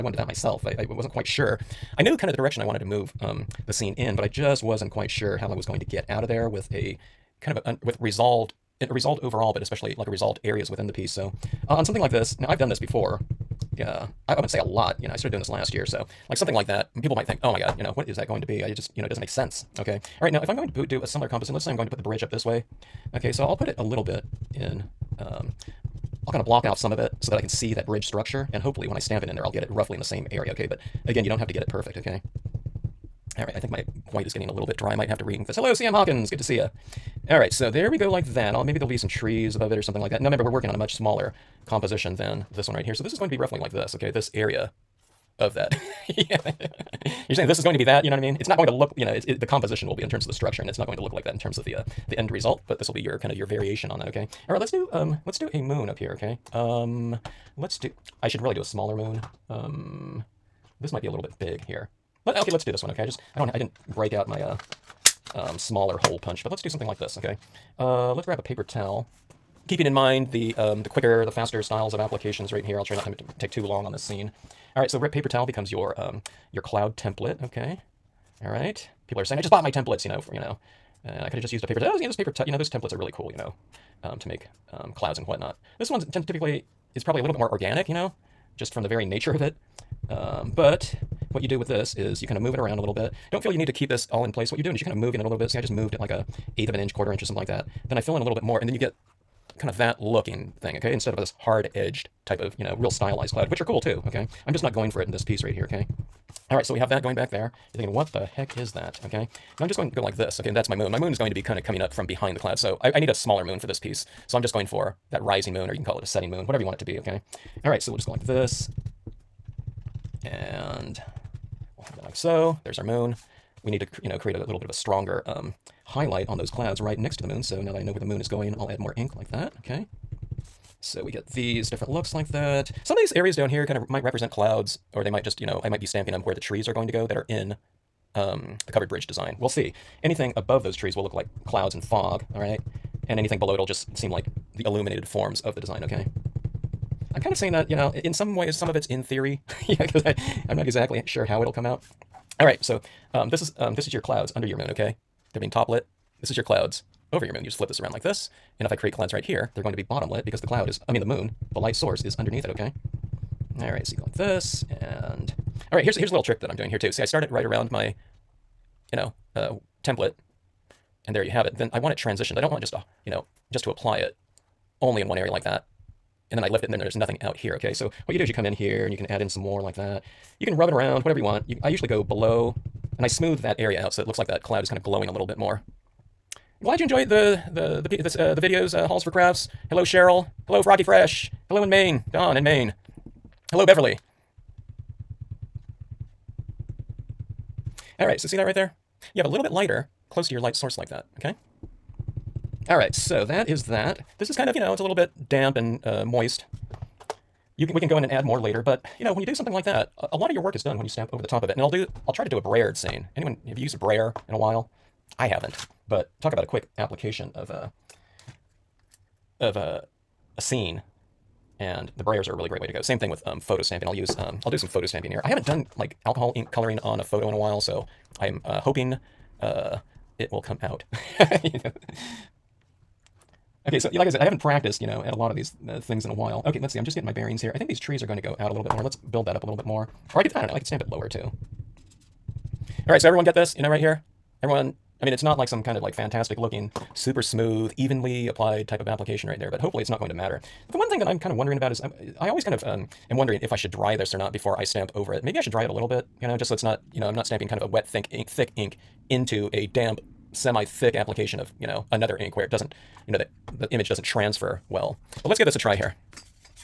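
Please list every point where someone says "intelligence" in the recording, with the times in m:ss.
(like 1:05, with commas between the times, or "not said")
not said.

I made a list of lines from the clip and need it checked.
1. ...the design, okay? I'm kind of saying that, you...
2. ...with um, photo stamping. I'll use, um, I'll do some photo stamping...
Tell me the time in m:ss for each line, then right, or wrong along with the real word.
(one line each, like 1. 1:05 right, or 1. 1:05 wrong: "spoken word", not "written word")
1. 2:25 right
2. 3:43 right.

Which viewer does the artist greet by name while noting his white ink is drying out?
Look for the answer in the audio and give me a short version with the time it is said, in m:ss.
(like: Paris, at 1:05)
CM Hawkins, at 0:35.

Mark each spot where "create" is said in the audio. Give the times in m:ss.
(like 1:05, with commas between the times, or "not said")
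2:04, 2:38.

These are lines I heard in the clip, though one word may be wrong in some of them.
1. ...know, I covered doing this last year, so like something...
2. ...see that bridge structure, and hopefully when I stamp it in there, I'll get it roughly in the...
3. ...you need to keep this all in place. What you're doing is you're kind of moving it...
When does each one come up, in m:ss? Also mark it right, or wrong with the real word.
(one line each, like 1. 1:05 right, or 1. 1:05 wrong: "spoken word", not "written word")
1. 0:15 wrong: "started", not "covered"
2. 0:27 right
3. 1:33 right.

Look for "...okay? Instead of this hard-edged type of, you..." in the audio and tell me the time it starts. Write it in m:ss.
1:40.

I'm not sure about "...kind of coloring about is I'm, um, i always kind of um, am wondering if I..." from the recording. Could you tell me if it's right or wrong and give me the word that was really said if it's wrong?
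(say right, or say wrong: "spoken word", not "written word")
wrong: "wondering", not "coloring".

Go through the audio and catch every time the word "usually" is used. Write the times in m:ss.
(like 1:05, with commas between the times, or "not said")
3:01.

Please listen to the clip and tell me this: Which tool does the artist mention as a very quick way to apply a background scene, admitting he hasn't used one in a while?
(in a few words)
Brayer.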